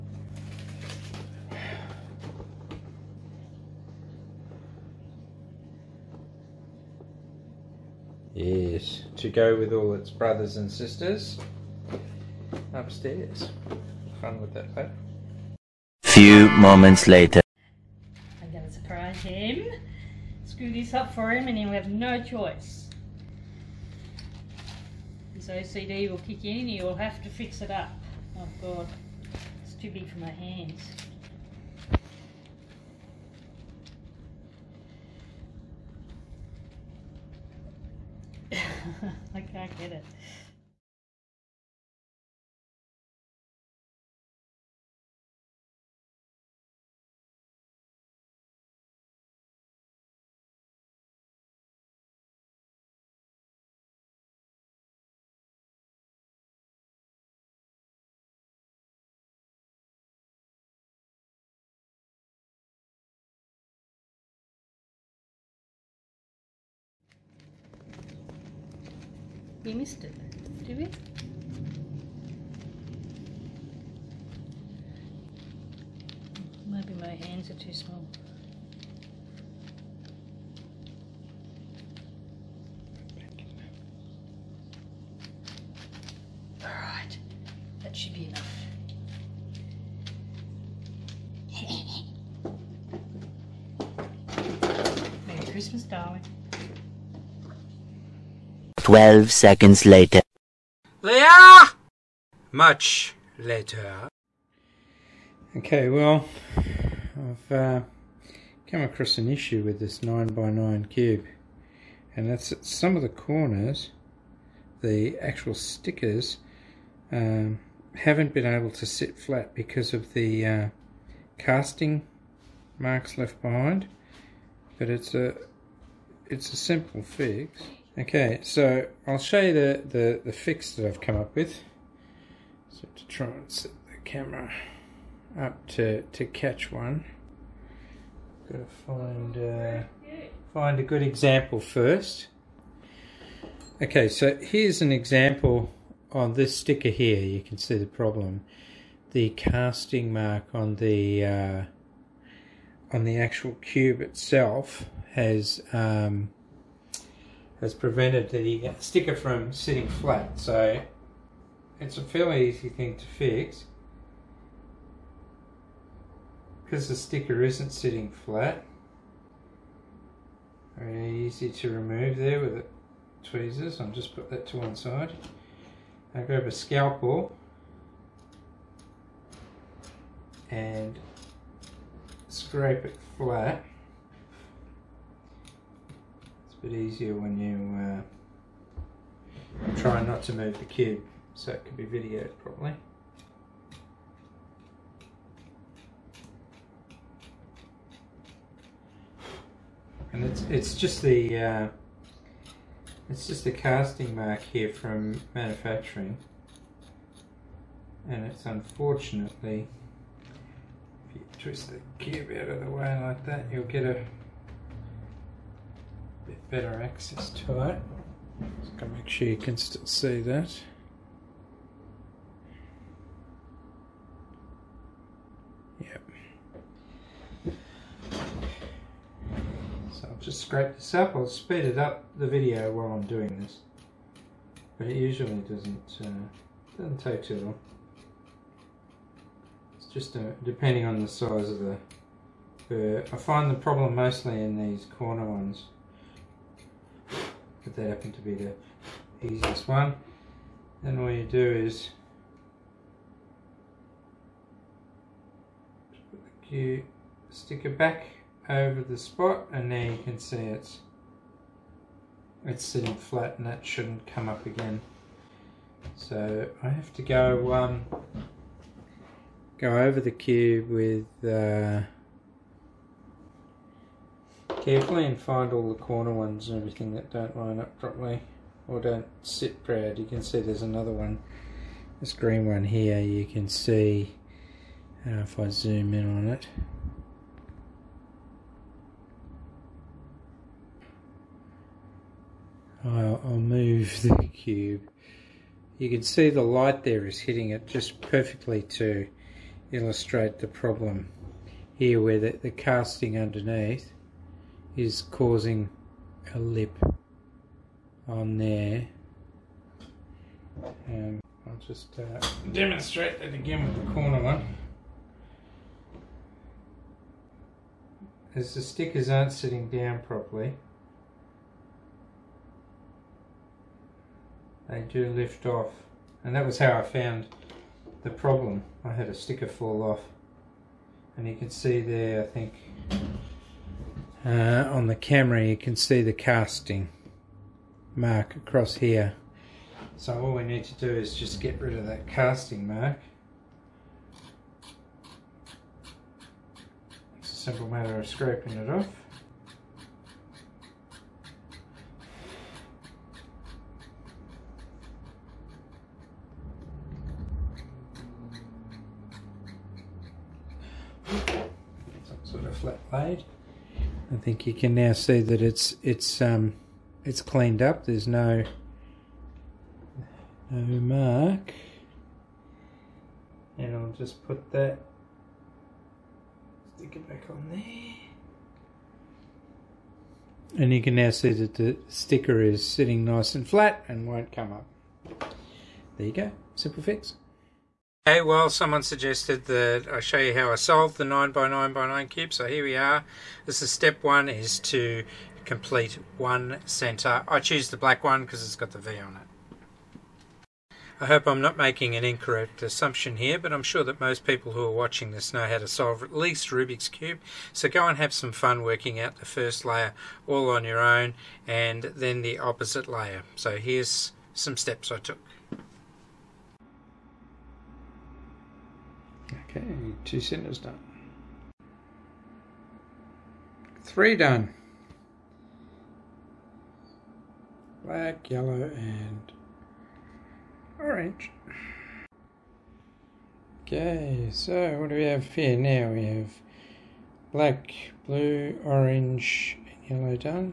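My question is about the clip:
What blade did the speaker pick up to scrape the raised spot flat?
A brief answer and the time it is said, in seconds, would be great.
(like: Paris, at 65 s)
Scalpel, at 176 s.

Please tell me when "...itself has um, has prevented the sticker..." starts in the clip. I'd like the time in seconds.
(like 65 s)
153 s.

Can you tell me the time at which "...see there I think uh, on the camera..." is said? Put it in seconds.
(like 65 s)
331 s.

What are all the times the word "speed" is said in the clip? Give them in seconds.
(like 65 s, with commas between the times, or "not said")
231 s.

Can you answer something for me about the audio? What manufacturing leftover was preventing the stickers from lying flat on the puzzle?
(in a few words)
Casting marks.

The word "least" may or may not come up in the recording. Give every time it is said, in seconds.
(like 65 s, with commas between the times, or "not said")
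406 s.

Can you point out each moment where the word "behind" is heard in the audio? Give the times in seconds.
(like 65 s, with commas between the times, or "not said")
123 s.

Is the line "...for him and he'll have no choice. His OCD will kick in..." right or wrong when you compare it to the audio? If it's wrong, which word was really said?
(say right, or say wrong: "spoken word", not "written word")
right.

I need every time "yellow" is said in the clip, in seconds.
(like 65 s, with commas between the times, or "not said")
428 s, 439 s.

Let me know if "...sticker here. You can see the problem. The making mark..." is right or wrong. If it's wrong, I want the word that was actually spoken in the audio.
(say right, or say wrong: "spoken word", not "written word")
wrong: "casting", not "making".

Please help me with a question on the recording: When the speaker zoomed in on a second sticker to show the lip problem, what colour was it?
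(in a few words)
Green.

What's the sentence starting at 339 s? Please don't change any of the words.
So all we need to do is just get rid of that casting mark.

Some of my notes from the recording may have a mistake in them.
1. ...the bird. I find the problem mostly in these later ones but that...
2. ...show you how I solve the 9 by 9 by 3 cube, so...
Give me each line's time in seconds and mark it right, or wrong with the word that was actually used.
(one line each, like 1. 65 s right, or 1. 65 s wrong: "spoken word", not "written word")
1. 241 s wrong: "corner", not "later"
2. 389 s wrong: "9", not "3".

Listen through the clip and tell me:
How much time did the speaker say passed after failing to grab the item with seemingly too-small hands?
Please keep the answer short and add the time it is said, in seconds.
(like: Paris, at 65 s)
12 seconds, at 98 s.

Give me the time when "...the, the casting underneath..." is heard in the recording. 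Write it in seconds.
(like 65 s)
302 s.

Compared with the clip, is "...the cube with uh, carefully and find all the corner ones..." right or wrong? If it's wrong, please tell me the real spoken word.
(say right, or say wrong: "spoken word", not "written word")
right.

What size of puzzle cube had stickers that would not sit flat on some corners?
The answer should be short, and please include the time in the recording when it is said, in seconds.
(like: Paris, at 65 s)
9x9, at 109 s.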